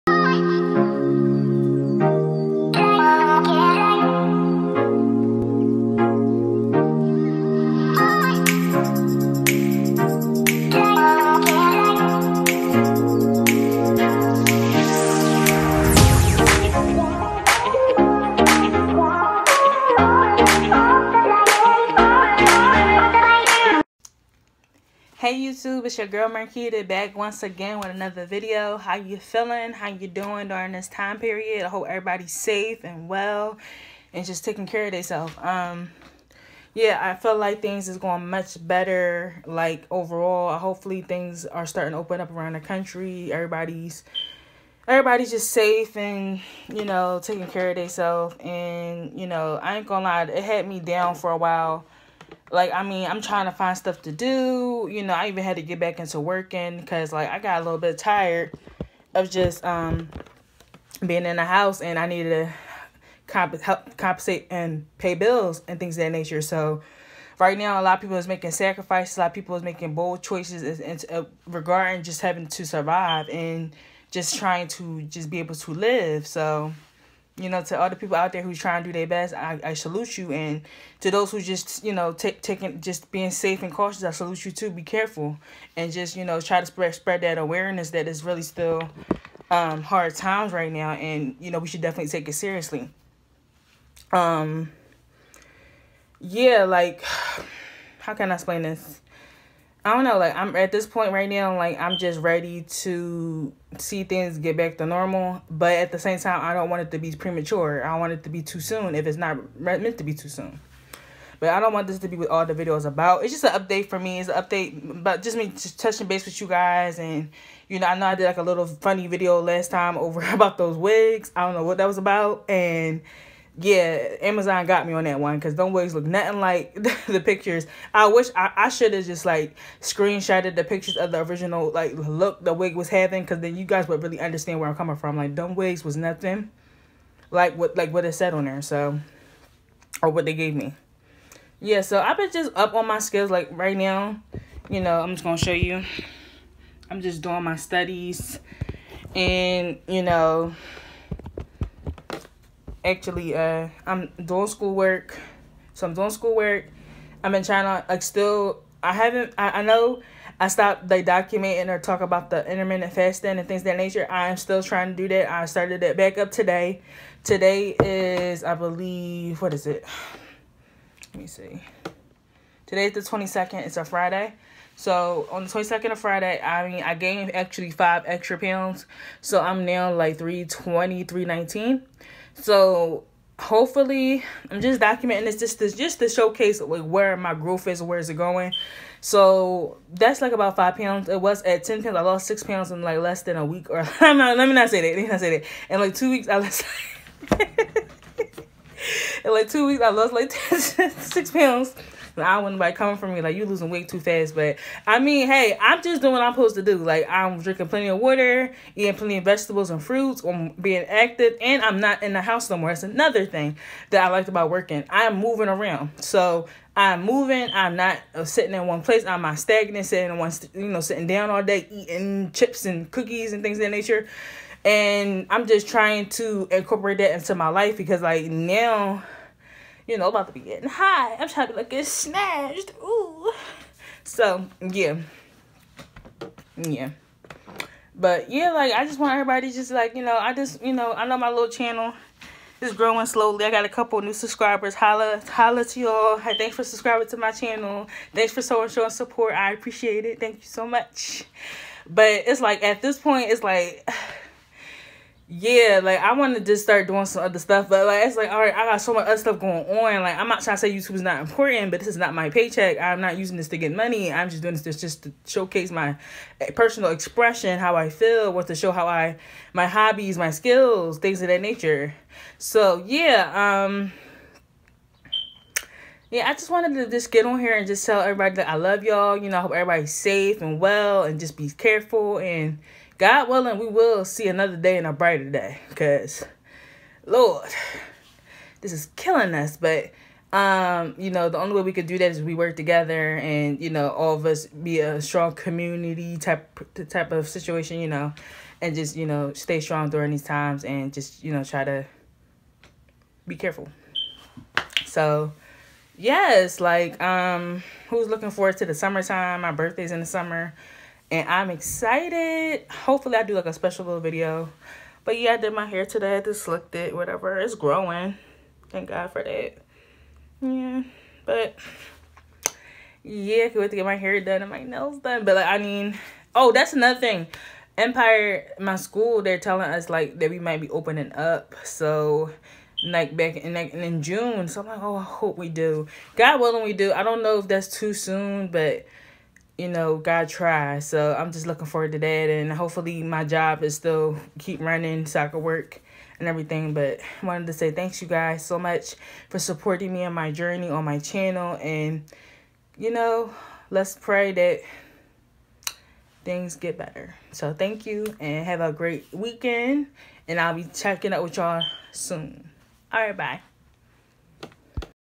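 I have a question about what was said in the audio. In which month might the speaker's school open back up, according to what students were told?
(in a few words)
June.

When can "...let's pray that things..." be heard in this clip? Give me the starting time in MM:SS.
05:53.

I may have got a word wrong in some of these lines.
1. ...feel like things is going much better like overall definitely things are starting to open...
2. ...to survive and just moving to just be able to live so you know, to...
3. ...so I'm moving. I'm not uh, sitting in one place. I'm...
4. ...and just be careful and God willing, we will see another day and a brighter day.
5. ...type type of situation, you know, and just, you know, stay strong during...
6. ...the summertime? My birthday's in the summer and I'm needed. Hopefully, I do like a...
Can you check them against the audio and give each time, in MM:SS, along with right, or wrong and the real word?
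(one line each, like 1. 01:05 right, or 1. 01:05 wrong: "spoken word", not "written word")
1. 00:37 wrong: "hopefully", not "definitely"
2. 01:12 wrong: "trying", not "moving"
3. 03:36 right
4. 04:41 right
5. 04:56 right
6. 05:08 wrong: "excited", not "needed".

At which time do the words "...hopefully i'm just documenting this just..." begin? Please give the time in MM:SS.
03:03.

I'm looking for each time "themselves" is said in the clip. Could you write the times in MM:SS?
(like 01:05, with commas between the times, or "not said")
00:34, 00:47.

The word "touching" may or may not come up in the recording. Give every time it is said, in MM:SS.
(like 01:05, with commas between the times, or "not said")
01:55.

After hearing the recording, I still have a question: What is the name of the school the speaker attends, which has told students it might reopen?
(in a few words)
Empire.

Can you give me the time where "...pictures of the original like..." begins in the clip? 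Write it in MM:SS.
02:10.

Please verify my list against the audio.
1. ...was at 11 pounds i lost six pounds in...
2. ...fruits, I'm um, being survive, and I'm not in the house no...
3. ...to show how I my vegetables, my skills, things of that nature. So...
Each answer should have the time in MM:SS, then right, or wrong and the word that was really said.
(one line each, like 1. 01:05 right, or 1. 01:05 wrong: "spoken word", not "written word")
1. 03:11 wrong: "10", not "11"
2. 03:29 wrong: "active", not "survive"
3. 04:28 wrong: "hobbies", not "vegetables".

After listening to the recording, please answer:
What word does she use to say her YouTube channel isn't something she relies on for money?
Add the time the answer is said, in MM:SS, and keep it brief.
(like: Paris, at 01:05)
paycheck, at 04:22.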